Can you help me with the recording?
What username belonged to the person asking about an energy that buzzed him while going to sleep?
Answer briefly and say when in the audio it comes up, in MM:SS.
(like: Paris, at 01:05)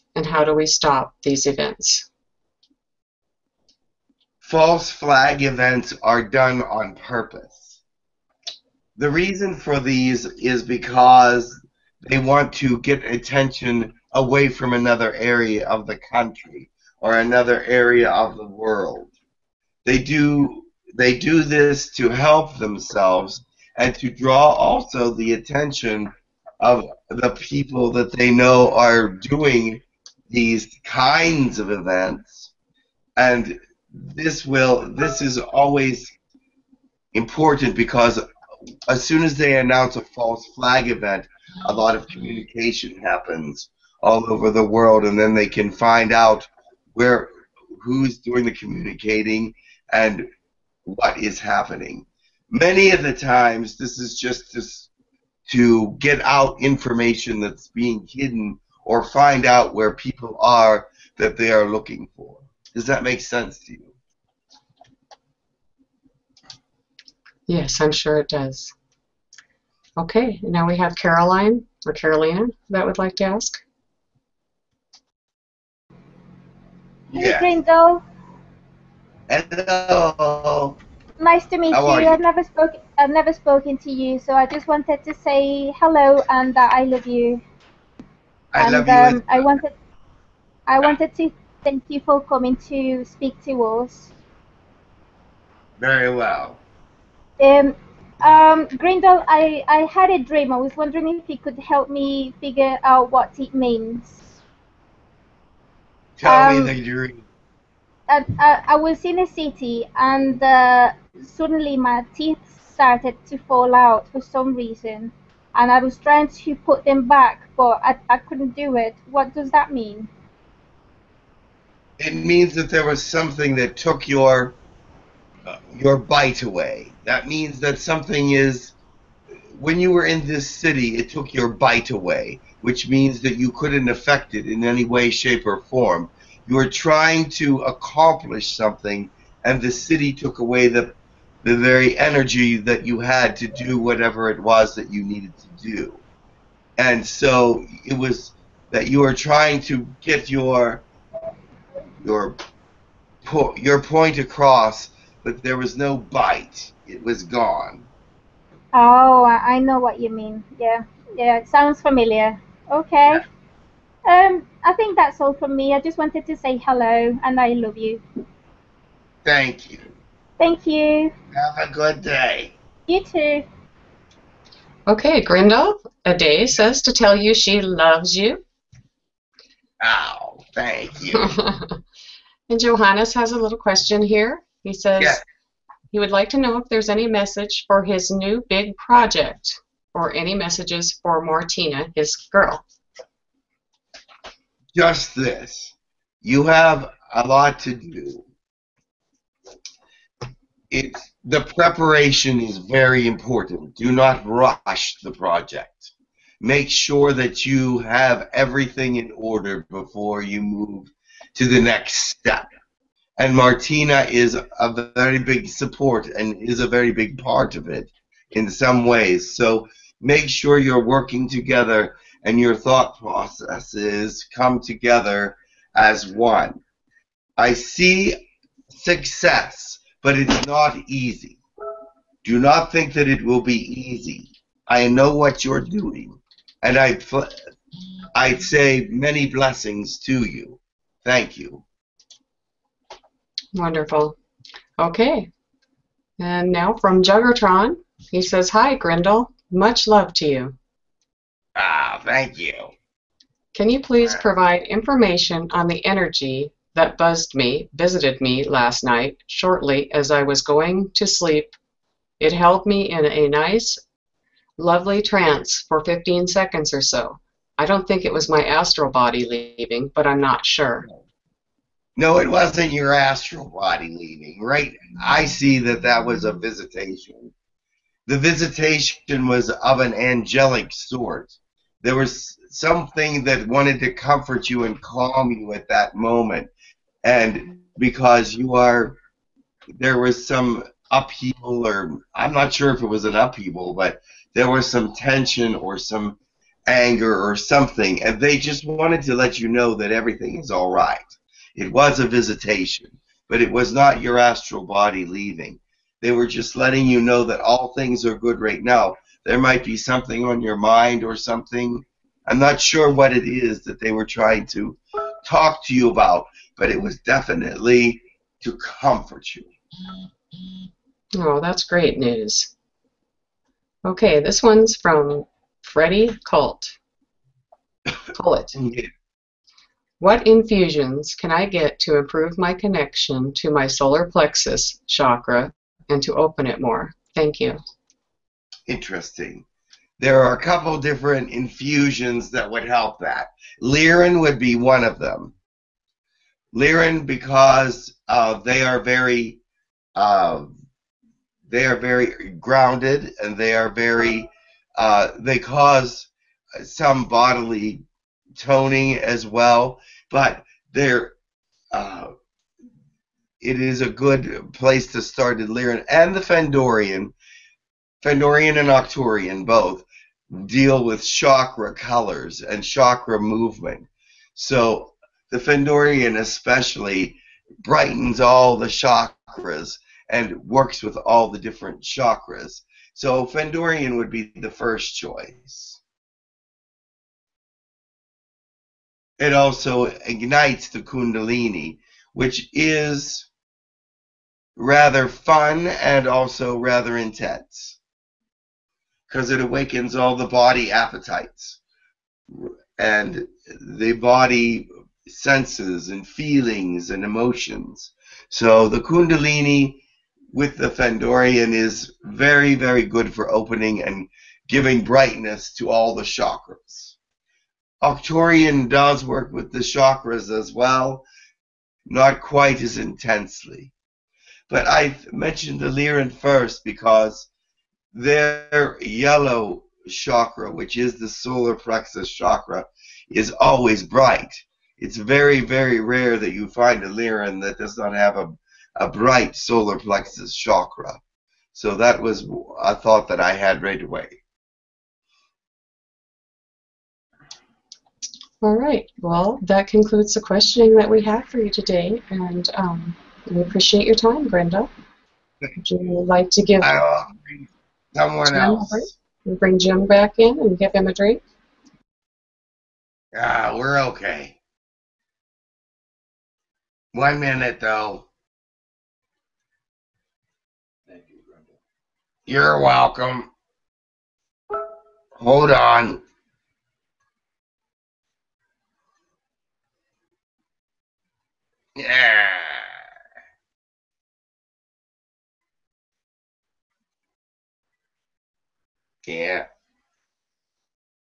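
Juggertron, at 04:07.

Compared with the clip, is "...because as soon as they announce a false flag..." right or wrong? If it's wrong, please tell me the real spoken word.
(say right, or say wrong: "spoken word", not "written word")
right.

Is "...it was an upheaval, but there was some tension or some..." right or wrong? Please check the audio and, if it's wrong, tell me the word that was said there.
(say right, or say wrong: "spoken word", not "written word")
right.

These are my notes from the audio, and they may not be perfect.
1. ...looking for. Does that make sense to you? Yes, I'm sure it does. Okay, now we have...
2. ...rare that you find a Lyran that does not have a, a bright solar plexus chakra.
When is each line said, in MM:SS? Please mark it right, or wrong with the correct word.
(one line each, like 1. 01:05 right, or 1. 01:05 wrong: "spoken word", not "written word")
1. 01:01 right
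2. 07:15 right.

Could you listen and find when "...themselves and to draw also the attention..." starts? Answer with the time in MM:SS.
00:22.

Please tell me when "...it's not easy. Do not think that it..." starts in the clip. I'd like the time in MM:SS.
03:50.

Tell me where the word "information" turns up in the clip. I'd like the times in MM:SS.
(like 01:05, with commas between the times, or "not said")
00:56, 04:14.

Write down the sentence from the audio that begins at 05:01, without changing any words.
It was a visitation, but it was not your astral body leaving.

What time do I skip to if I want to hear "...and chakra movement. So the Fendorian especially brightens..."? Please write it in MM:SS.
06:12.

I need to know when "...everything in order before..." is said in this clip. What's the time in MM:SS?
03:28.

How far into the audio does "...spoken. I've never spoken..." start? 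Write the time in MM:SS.
01:22.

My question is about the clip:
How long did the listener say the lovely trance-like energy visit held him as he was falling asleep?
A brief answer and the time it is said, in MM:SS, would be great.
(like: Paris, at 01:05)
15 seconds, at 04:25.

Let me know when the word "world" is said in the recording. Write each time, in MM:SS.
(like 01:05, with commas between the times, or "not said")
00:18, 00:44.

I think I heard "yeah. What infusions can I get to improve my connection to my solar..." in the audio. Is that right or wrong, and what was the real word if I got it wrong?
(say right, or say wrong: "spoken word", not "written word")
right.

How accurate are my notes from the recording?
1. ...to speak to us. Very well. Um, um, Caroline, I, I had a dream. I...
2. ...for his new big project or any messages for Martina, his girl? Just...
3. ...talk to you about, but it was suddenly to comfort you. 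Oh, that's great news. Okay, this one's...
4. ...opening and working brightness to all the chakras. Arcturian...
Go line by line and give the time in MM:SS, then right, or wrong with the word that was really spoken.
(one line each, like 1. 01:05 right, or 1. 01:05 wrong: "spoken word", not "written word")
1. 01:32 wrong: "Grindal", not "Caroline"
2. 03:07 right
3. 05:15 wrong: "definitely", not "suddenly"
4. 06:53 wrong: "giving", not "working".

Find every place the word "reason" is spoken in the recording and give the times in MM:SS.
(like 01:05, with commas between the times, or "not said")
00:09, 01:54.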